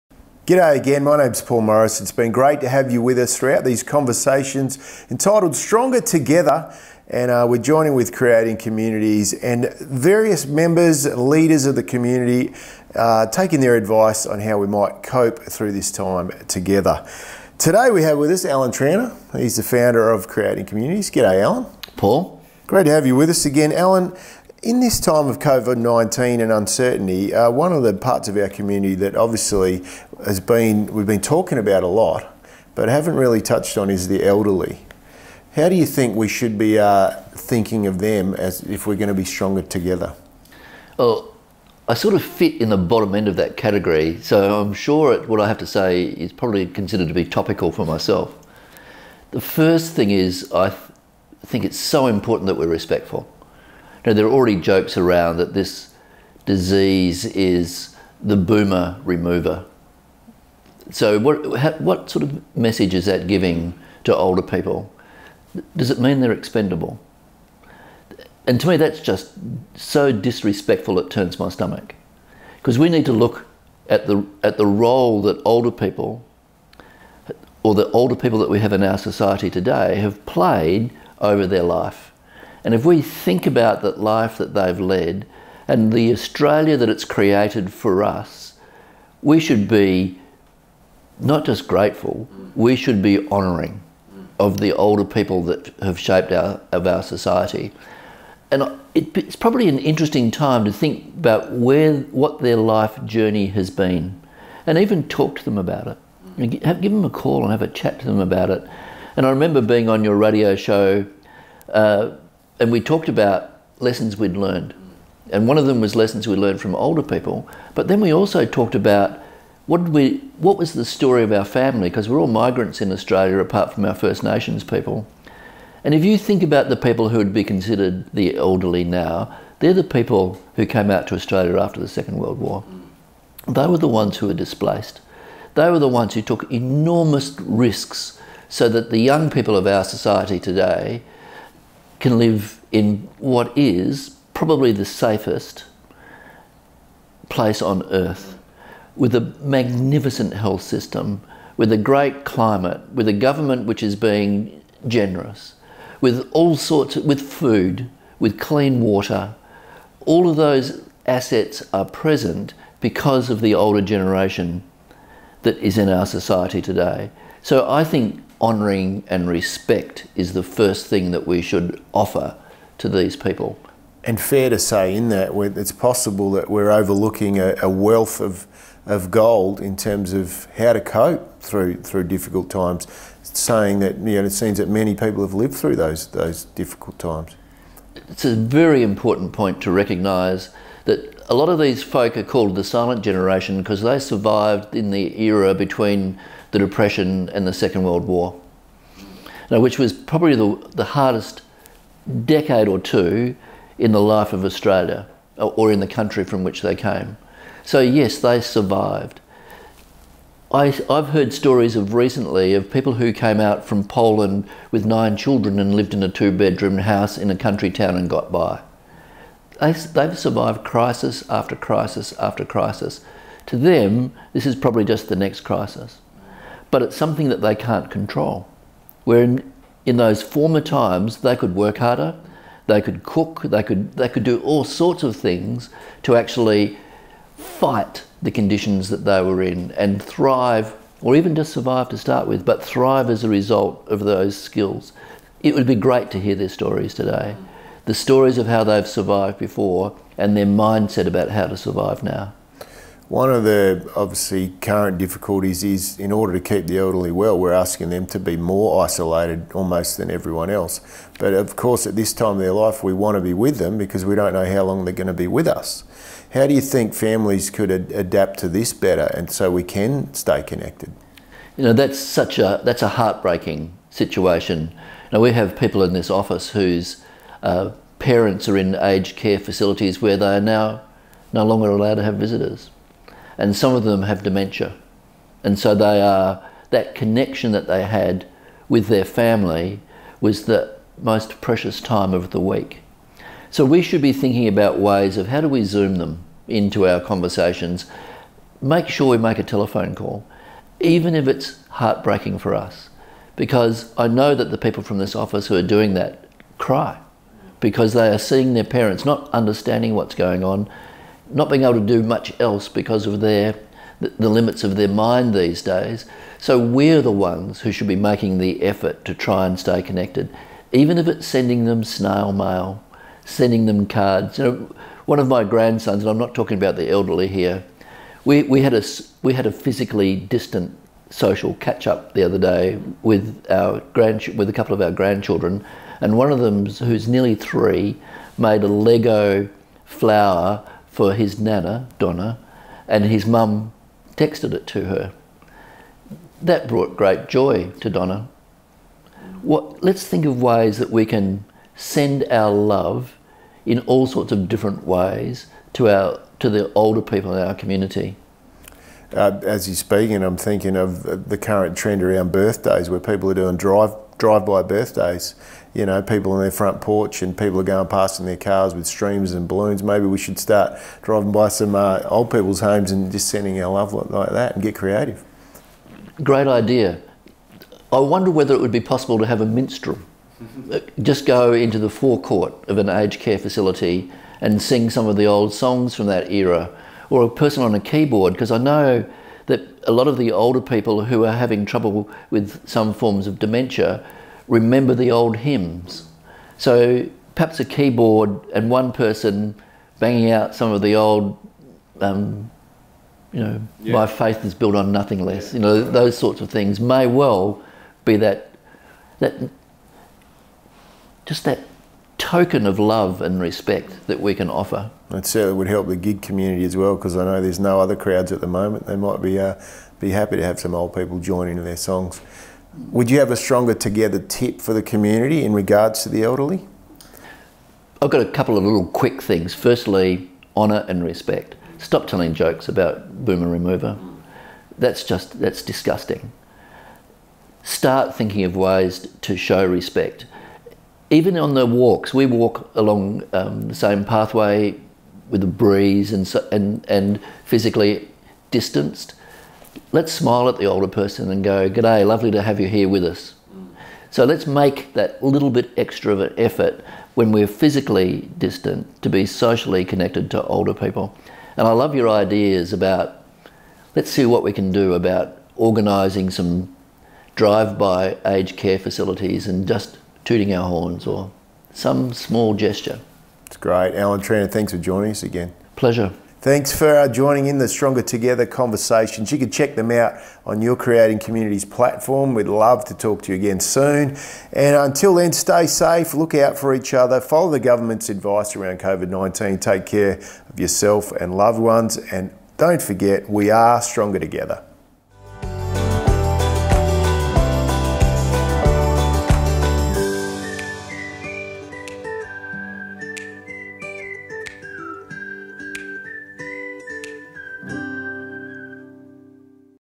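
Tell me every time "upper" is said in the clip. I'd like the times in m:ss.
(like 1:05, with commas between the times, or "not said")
not said.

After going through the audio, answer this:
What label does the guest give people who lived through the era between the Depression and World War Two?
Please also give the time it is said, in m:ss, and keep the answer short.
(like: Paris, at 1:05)
the silent generation, at 3:12.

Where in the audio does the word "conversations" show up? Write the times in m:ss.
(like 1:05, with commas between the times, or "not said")
0:03, 4:57, 7:58.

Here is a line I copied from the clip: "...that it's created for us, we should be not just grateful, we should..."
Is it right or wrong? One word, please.
right.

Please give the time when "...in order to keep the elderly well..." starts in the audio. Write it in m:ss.
4:15.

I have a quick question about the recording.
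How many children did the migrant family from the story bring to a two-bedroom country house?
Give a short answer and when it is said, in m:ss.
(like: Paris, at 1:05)
9, at 3:34.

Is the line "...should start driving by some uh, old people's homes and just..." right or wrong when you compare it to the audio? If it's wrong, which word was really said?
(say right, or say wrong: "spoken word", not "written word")
right.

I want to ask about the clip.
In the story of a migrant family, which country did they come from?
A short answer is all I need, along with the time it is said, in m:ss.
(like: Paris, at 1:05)
Poland, at 3:33.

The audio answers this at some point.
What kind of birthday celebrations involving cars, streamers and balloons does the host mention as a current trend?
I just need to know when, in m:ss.
6:04.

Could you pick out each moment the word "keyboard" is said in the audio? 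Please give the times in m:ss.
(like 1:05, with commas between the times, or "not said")
6:27, 6:37.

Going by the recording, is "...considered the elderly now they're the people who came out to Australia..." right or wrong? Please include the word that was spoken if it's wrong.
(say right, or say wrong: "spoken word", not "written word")
right.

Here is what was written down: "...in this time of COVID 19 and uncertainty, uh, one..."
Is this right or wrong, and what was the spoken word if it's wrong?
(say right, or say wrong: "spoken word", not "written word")
right.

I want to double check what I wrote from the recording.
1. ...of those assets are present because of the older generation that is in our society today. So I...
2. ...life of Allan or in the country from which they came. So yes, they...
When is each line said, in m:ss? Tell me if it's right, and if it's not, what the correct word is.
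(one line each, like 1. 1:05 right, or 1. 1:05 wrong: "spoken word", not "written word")
1. 2:40 right
2. 3:24 wrong: "Australia", not "Allan".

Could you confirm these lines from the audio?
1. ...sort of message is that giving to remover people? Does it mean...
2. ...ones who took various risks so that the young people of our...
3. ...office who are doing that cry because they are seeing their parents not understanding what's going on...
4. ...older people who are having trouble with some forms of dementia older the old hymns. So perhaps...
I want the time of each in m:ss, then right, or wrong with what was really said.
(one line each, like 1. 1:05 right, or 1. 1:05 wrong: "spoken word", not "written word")
1. 1:02 wrong: "older", not "remover"
2. 2:15 wrong: "enormous", not "various"
3. 5:05 right
4. 6:30 wrong: "remember", not "older".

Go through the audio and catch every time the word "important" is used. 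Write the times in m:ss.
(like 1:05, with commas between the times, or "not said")
0:52, 3:08.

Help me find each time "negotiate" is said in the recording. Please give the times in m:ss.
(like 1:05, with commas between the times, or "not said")
not said.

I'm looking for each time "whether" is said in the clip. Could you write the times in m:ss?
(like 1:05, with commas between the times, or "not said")
6:18.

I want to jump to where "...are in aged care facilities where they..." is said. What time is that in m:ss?
4:38.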